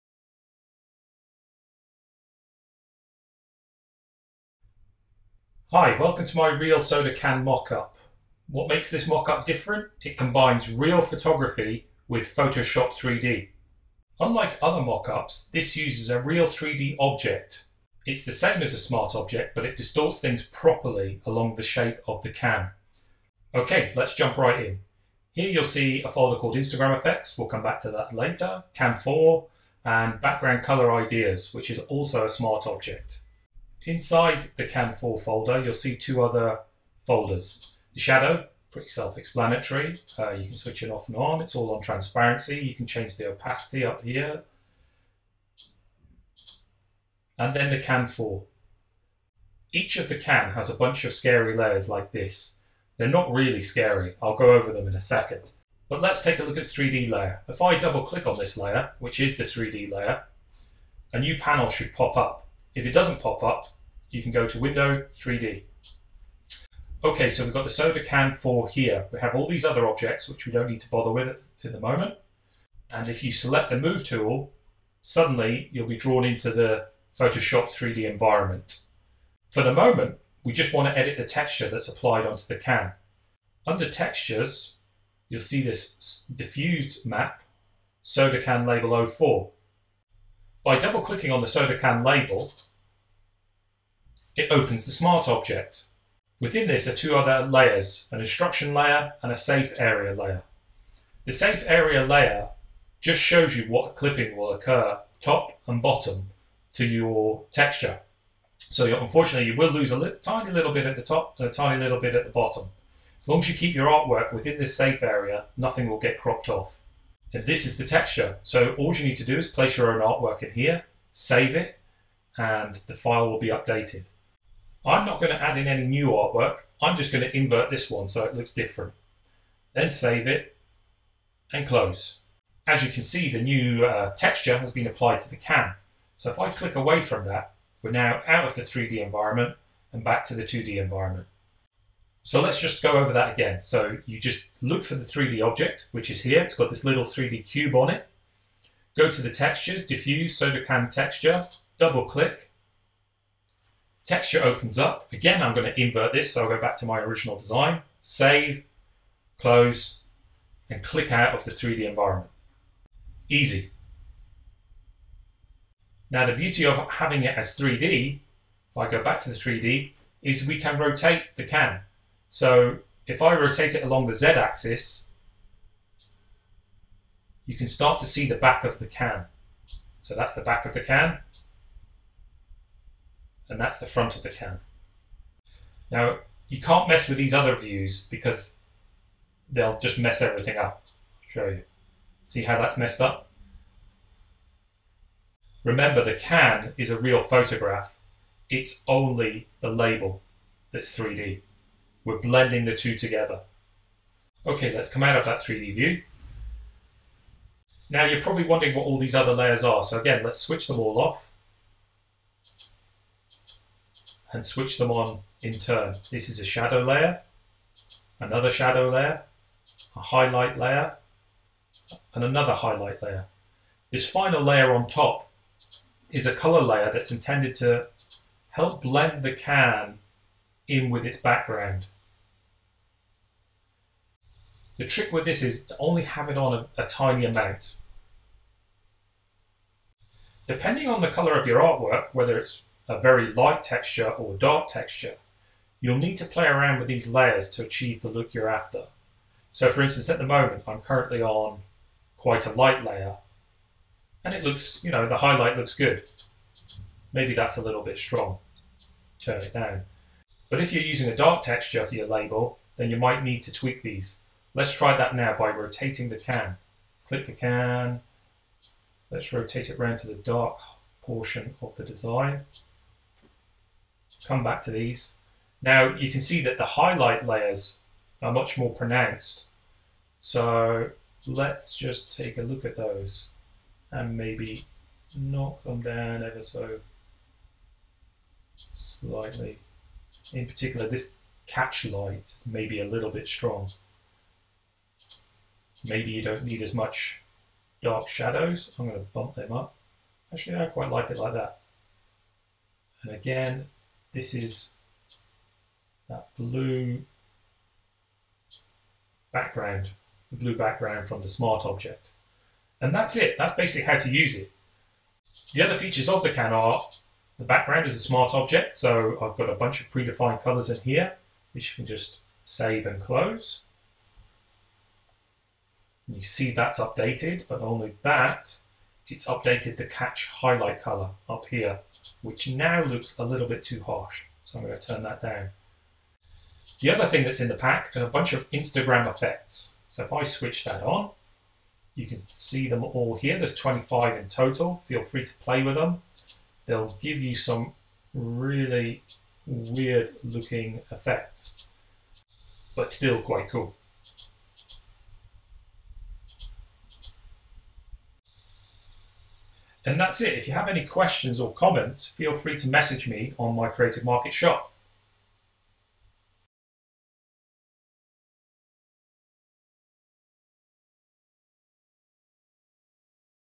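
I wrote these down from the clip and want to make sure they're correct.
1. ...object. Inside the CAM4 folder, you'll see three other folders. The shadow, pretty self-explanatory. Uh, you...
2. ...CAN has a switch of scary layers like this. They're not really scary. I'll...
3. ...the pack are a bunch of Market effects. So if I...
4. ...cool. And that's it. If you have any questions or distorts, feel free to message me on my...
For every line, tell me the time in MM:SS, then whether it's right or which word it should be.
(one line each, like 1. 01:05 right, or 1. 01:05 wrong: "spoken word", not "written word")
1. 00:32 wrong: "two", not "three"
2. 00:50 wrong: "bunch", not "switch"
3. 05:37 wrong: "Instagram", not "Market"
4. 05:53 wrong: "comments", not "distorts".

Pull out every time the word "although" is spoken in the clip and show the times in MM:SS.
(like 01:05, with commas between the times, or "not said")
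not said.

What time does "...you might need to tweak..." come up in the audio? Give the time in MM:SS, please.
04:22.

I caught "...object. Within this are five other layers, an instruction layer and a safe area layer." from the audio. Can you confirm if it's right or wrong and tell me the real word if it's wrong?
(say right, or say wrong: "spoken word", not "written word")
wrong: "two", not "five".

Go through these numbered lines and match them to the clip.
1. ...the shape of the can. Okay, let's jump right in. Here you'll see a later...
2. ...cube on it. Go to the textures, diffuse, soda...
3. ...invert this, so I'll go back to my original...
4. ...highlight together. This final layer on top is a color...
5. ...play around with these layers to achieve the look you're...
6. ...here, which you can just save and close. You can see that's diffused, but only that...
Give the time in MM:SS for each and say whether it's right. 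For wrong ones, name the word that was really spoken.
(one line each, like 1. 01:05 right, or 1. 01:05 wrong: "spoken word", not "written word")
1. 00:21 wrong: "folder", not "later"
2. 02:27 right
3. 02:35 right
4. 03:42 wrong: "layer", not "together"
5. 04:06 right
6. 05:20 wrong: "updated", not "diffused".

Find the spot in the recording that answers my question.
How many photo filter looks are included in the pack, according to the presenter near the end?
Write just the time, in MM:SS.
05:43.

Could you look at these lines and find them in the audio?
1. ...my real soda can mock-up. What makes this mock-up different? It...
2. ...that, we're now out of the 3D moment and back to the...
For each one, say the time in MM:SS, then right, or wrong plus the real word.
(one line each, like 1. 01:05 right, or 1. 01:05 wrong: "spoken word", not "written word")
1. 00:06 right
2. 02:17 wrong: "environment", not "moment".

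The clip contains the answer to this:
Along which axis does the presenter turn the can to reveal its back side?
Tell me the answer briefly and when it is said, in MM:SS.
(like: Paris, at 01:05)
Z-axis, at 02:54.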